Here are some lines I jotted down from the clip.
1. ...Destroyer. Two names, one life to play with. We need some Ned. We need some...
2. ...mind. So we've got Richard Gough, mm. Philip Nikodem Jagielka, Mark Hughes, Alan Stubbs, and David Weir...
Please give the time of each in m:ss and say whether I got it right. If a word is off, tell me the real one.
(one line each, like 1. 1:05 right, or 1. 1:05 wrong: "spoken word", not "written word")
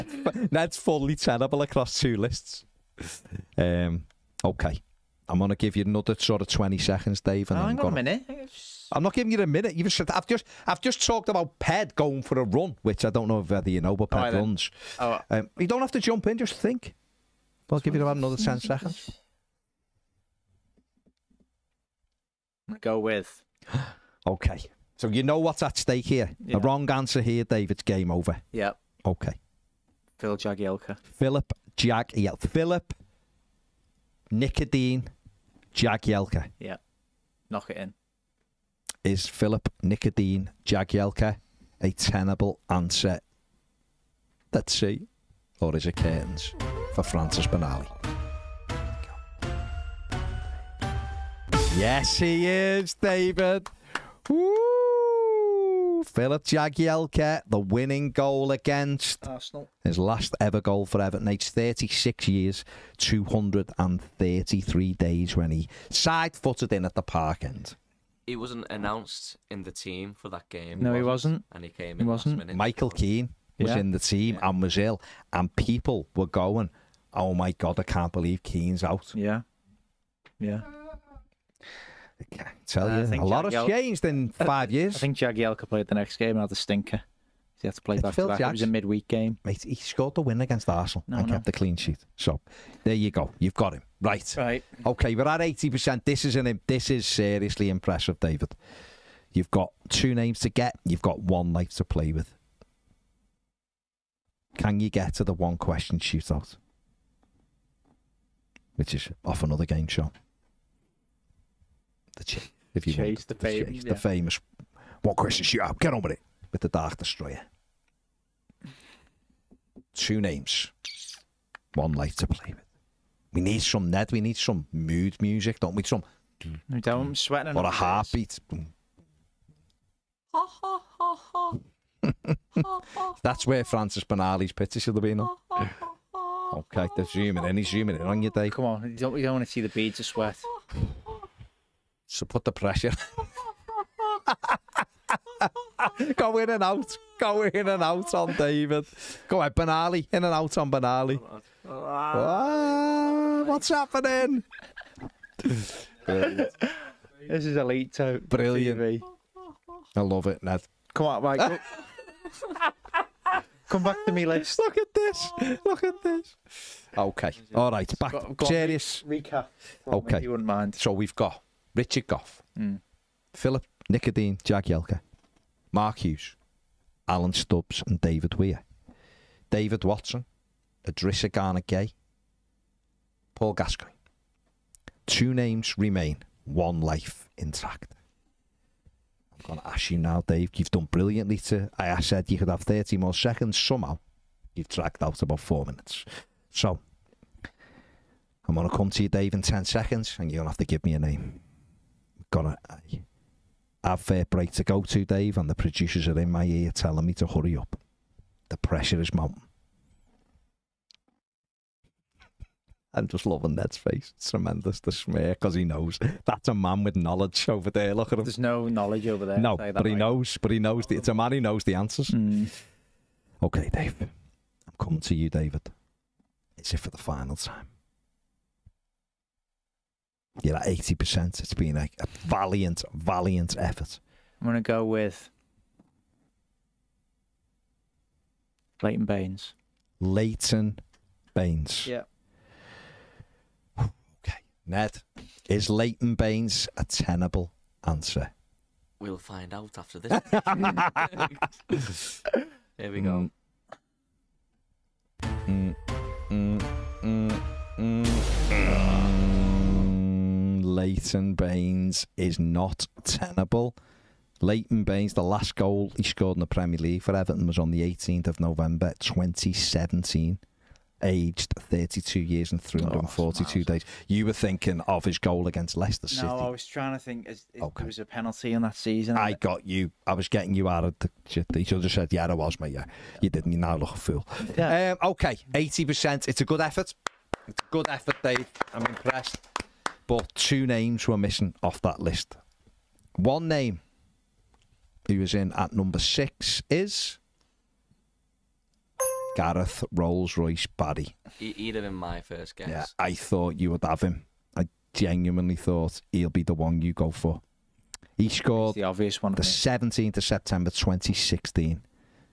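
1. 1:56 right
2. 2:50 right.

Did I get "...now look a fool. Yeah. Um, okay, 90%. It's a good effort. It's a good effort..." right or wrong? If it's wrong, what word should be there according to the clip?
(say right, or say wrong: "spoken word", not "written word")
wrong: "80", not "90".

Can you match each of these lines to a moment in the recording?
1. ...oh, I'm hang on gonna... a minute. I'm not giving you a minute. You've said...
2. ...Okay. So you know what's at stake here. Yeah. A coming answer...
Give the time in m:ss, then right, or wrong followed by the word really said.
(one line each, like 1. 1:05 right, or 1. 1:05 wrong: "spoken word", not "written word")
1. 0:07 right
2. 0:24 wrong: "wrong", not "coming".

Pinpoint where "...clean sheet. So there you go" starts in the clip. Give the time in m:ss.
1:31.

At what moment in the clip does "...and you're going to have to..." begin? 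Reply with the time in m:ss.
3:20.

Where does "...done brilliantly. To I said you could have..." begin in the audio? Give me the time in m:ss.
3:10.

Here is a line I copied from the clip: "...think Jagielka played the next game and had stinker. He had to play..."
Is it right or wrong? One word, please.
right.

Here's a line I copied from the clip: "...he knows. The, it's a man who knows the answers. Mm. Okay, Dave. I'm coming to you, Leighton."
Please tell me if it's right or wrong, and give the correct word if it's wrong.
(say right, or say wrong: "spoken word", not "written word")
wrong: "David", not "Leighton".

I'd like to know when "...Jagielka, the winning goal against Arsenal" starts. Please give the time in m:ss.
0:56.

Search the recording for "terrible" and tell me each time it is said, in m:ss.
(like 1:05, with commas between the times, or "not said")
0:01.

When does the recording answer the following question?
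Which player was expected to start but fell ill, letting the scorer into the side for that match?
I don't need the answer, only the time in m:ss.
1:12.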